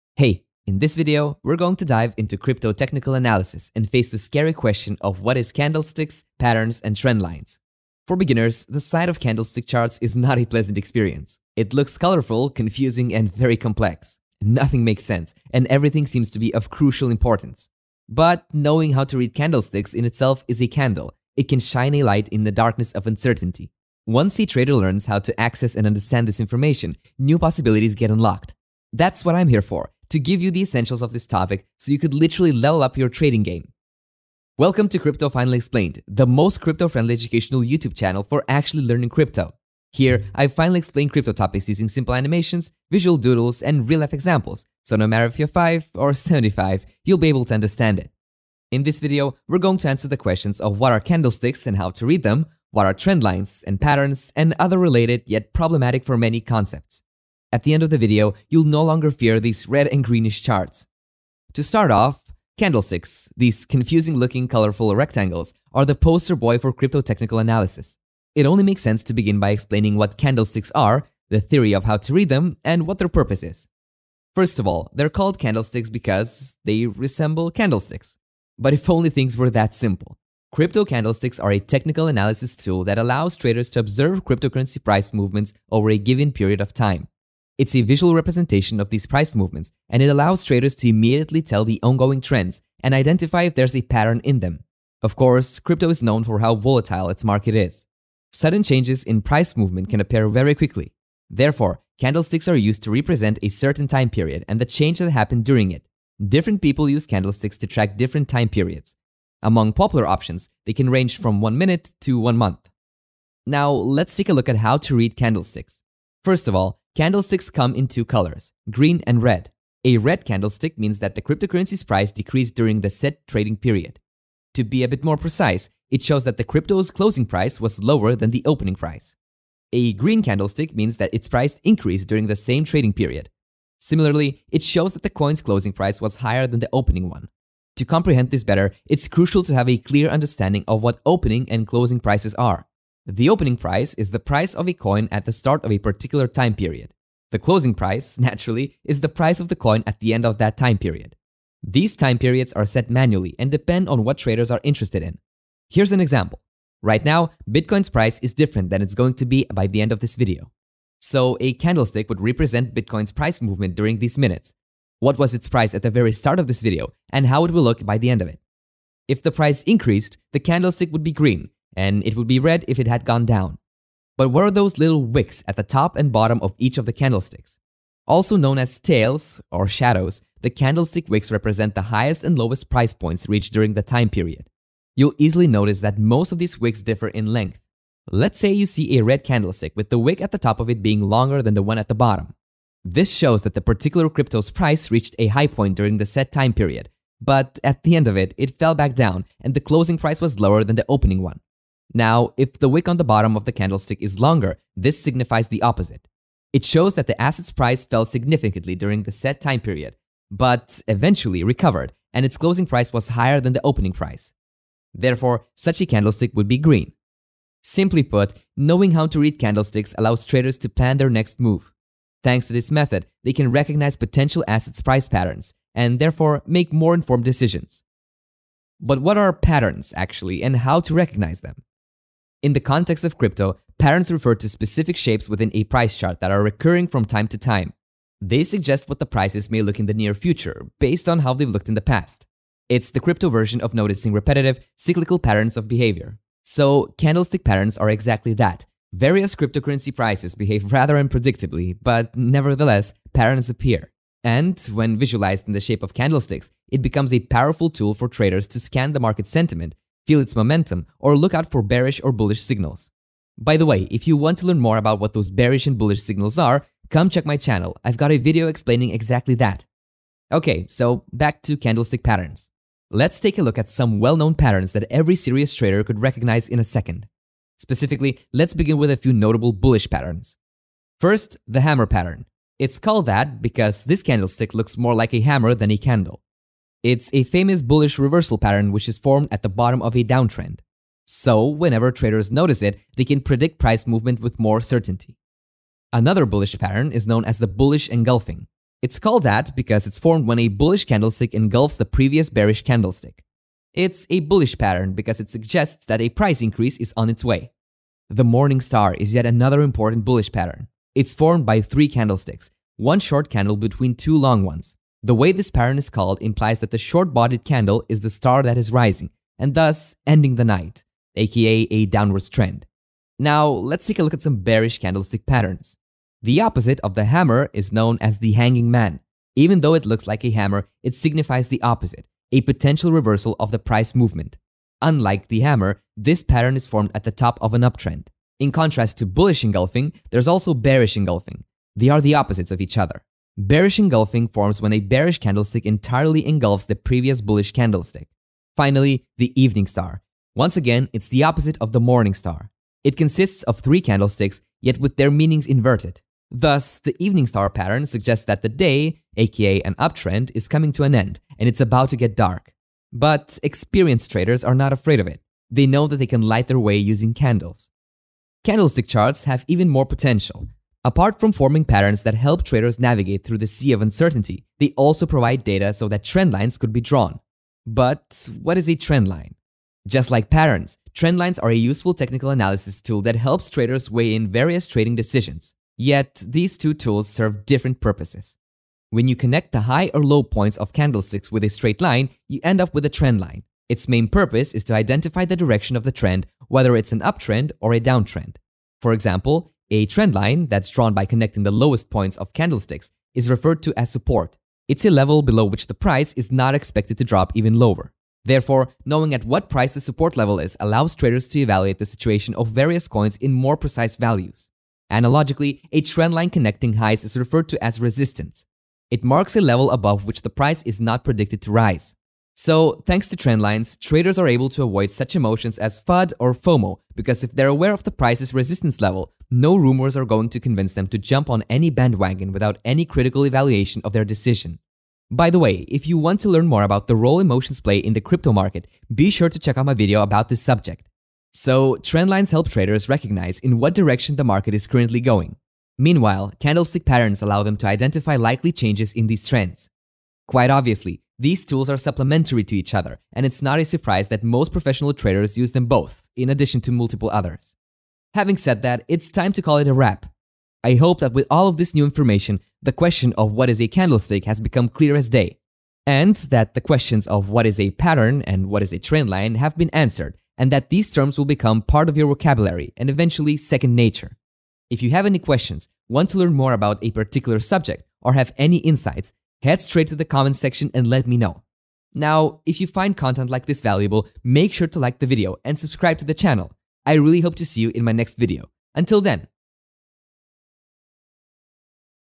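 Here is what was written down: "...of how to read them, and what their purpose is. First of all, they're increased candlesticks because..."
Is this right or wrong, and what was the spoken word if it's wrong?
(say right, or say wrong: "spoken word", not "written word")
wrong: "called", not "increased".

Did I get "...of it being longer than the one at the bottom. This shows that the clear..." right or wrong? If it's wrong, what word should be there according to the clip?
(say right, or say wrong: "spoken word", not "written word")
wrong: "particular", not "clear".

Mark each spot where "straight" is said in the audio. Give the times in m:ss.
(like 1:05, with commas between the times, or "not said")
6:31, 7:59.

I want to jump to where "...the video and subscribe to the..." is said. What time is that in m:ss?
8:04.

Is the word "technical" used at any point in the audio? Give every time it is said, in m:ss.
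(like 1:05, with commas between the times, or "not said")
0:02, 1:06, 1:21, 6:21.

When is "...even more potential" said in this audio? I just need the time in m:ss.
6:09.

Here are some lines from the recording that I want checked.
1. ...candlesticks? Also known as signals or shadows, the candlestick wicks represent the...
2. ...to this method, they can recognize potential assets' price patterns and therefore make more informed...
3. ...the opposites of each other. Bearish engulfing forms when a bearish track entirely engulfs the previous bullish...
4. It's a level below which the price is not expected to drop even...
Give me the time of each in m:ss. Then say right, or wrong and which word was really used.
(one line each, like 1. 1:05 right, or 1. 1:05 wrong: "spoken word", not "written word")
1. 2:56 wrong: "tails", not "signals"
2. 3:42 right
3. 5:42 wrong: "candlestick", not "track"
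4. 6:44 right.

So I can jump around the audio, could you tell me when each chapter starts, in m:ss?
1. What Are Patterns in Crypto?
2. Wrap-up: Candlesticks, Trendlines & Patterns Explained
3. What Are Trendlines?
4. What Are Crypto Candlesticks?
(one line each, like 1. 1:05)
1. 3:48
2. 7:37
3. 6:07
4. 1:00.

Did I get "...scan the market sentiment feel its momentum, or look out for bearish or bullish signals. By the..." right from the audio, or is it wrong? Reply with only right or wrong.
right.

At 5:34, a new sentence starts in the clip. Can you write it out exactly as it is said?
Unlike the hammer, this pattern is formed at the top of an uptrend.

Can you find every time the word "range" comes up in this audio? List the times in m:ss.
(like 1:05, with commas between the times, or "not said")
1:50.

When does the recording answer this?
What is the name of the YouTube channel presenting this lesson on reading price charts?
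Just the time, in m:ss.
0:34.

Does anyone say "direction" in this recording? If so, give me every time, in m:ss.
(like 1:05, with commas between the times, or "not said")
6:35, 7:23.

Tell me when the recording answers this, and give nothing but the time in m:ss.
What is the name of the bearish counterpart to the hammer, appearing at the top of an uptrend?
5:28.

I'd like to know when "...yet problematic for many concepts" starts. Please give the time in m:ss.
0:55.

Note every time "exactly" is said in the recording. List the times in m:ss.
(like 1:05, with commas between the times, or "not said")
4:07, 4:28.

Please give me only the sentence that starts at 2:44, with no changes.
What was its price at the very start of this video and how it will look by the end of it.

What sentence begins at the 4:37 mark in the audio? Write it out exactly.
Specifically, let's begin with a few notable bullish patterns.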